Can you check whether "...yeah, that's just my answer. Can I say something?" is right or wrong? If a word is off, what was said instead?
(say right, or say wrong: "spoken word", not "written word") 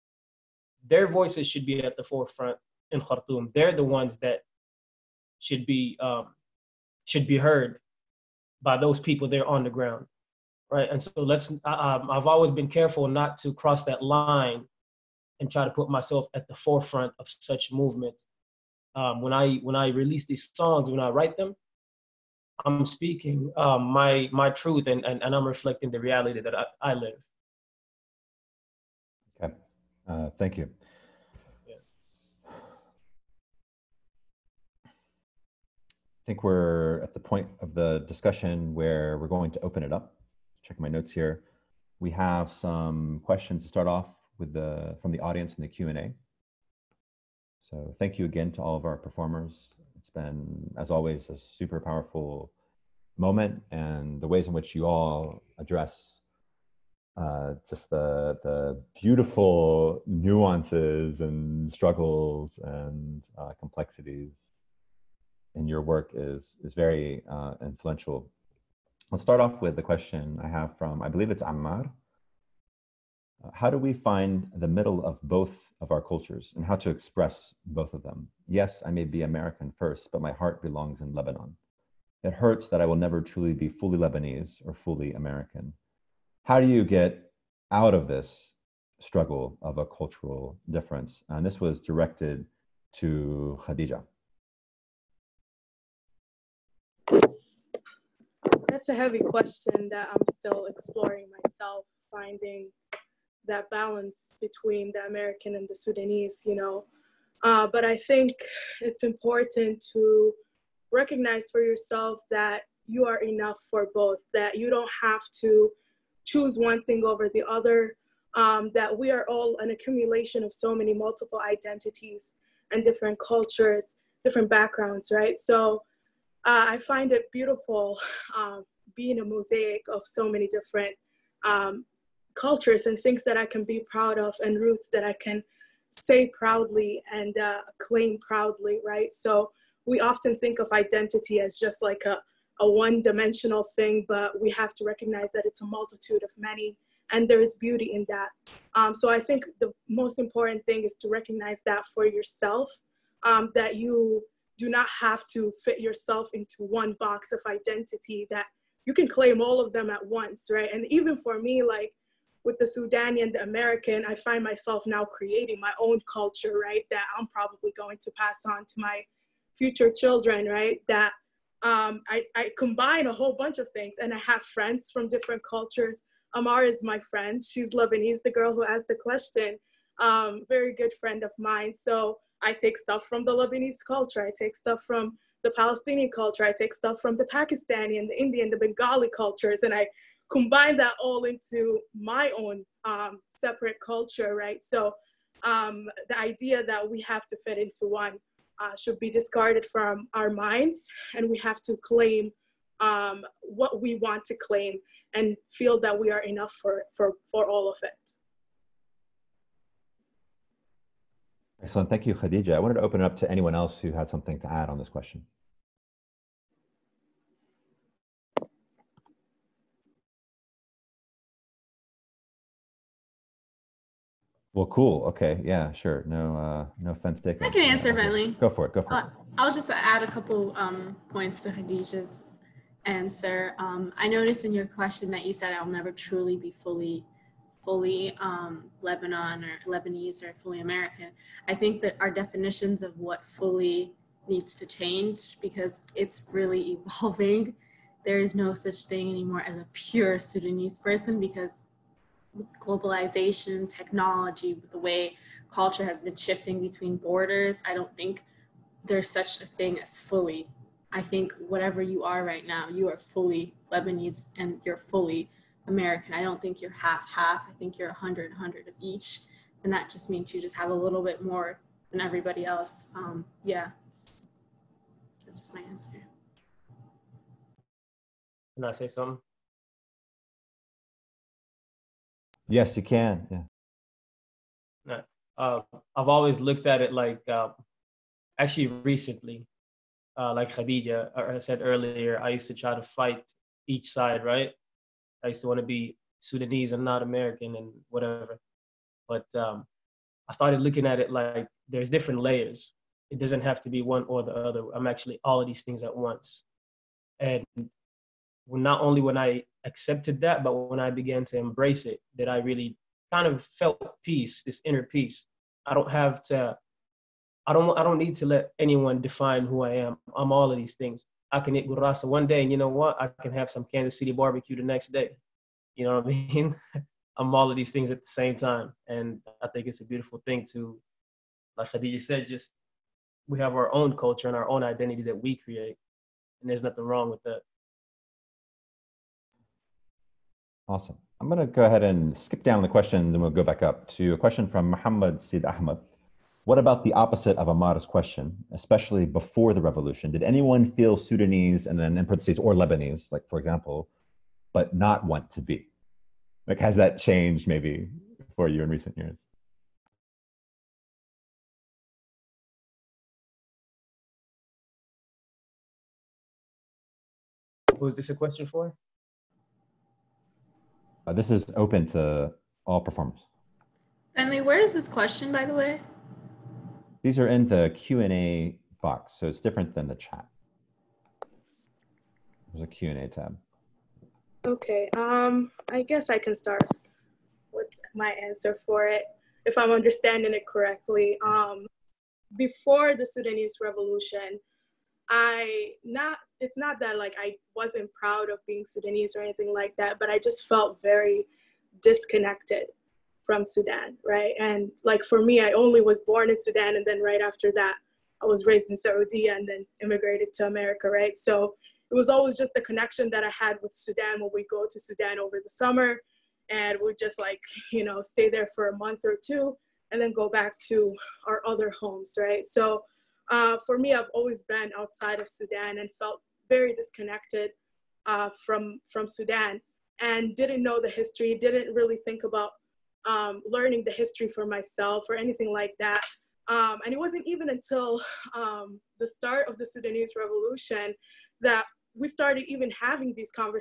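right.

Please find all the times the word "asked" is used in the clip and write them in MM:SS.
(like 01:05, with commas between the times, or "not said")
02:58.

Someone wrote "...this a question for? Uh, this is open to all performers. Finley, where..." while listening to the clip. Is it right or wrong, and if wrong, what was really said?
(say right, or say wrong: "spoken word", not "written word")
right.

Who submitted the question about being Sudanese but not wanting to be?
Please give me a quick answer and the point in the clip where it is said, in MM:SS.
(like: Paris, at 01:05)
Muhammad Sid Ahmed, at 05:44.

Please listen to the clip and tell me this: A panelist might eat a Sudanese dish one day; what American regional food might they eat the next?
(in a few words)
Kansas City barbecue.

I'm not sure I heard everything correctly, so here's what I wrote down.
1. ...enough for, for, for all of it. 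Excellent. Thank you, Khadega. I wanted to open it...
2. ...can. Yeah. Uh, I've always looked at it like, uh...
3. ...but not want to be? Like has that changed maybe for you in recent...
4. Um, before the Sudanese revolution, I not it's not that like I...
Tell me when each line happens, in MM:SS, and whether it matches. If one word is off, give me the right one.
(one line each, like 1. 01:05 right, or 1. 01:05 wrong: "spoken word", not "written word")
1. 03:26 right
2. 04:42 right
3. 05:54 right
4. 06:31 right.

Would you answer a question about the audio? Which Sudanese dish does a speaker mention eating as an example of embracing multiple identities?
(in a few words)
gurasa.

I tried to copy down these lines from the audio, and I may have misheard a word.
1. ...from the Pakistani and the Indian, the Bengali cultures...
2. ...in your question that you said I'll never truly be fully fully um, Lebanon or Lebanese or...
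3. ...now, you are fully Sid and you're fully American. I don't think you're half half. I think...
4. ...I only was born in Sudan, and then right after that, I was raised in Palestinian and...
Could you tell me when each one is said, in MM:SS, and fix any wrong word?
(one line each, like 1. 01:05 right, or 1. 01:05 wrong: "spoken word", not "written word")
1. 03:07 right
2. 03:54 right
3. 04:22 wrong: "Lebanese", not "Sid"
4. 06:45 wrong: "Saudi", not "Palestinian".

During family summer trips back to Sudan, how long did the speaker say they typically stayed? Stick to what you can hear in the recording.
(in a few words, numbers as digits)
a month or two.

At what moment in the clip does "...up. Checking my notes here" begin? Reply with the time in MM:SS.
00:39.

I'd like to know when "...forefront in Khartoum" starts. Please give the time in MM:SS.
00:02.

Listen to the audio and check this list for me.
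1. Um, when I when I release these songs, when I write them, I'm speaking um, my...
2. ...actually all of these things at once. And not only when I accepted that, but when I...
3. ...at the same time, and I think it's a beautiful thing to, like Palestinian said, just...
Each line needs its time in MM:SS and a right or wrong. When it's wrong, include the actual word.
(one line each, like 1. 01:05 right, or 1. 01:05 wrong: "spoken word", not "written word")
1. 00:18 right
2. 05:04 right
3. 05:27 wrong: "Khadega", not "Palestinian".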